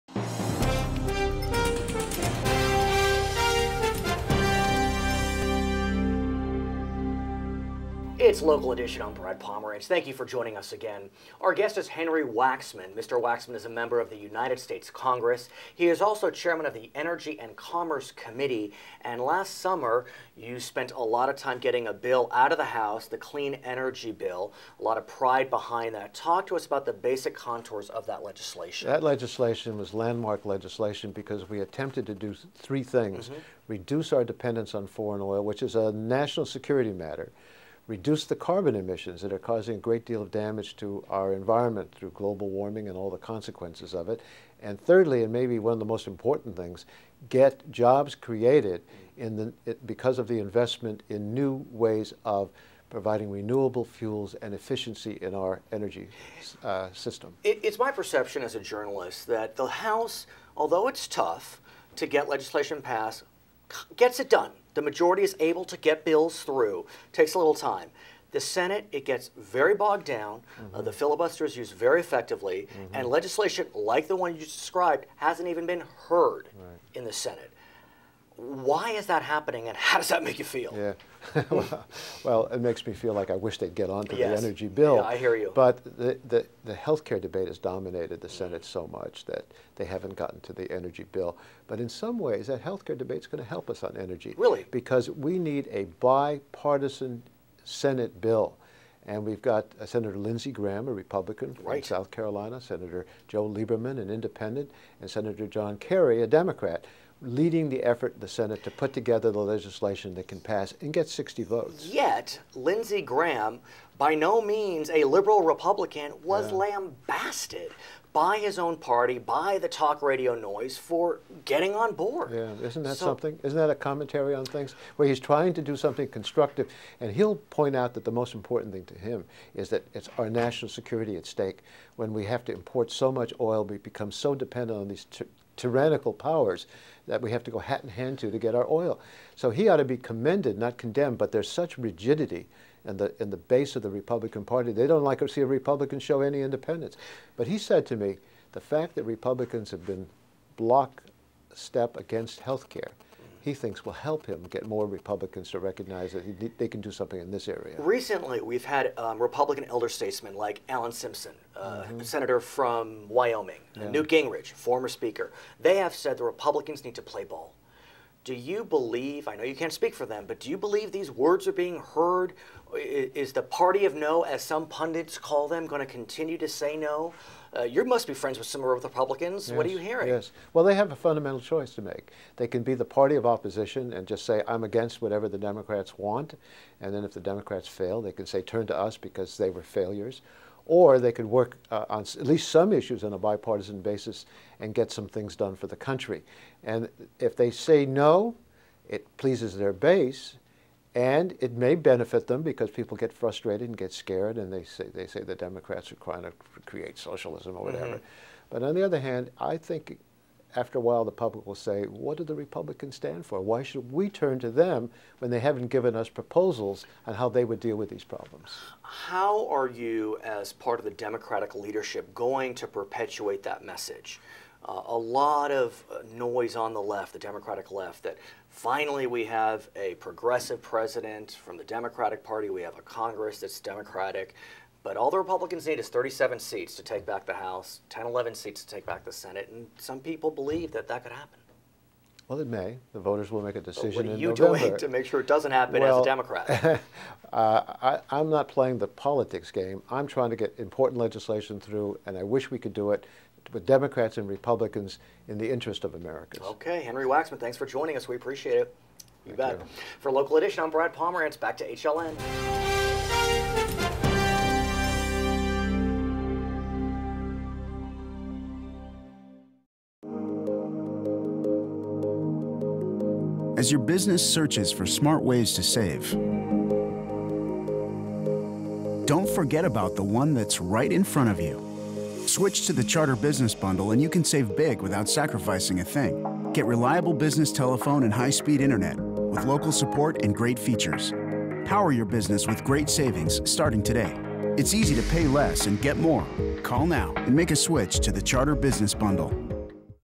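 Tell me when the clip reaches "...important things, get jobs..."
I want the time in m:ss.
0:46.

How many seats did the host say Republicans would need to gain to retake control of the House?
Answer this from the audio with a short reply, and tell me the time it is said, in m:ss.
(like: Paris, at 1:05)
37, at 3:55.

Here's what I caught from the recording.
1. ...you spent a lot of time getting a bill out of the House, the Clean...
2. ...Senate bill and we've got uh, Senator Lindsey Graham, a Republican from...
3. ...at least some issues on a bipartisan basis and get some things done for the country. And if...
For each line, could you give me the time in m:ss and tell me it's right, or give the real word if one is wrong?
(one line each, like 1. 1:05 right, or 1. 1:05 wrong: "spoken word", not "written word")
1. 0:20 right
2. 1:37 right
3. 3:12 right.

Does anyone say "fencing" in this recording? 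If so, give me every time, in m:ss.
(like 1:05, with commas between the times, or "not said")
not said.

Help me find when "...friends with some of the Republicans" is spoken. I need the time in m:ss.
2:58.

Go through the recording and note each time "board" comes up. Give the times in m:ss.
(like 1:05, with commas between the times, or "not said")
2:01.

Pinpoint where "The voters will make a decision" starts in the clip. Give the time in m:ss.
4:02.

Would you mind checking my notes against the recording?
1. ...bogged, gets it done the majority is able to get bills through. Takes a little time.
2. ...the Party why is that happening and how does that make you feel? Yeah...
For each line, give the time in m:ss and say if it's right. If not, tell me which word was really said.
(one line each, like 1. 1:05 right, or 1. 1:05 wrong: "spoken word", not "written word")
1. 1:02 wrong: "passed", not "bogged"
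2. 1:17 wrong: "Senate", not "Party".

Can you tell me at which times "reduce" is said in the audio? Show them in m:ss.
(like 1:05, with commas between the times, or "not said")
0:33, 0:37.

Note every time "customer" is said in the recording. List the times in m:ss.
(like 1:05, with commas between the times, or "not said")
not said.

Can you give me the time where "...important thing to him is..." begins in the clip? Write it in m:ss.
2:08.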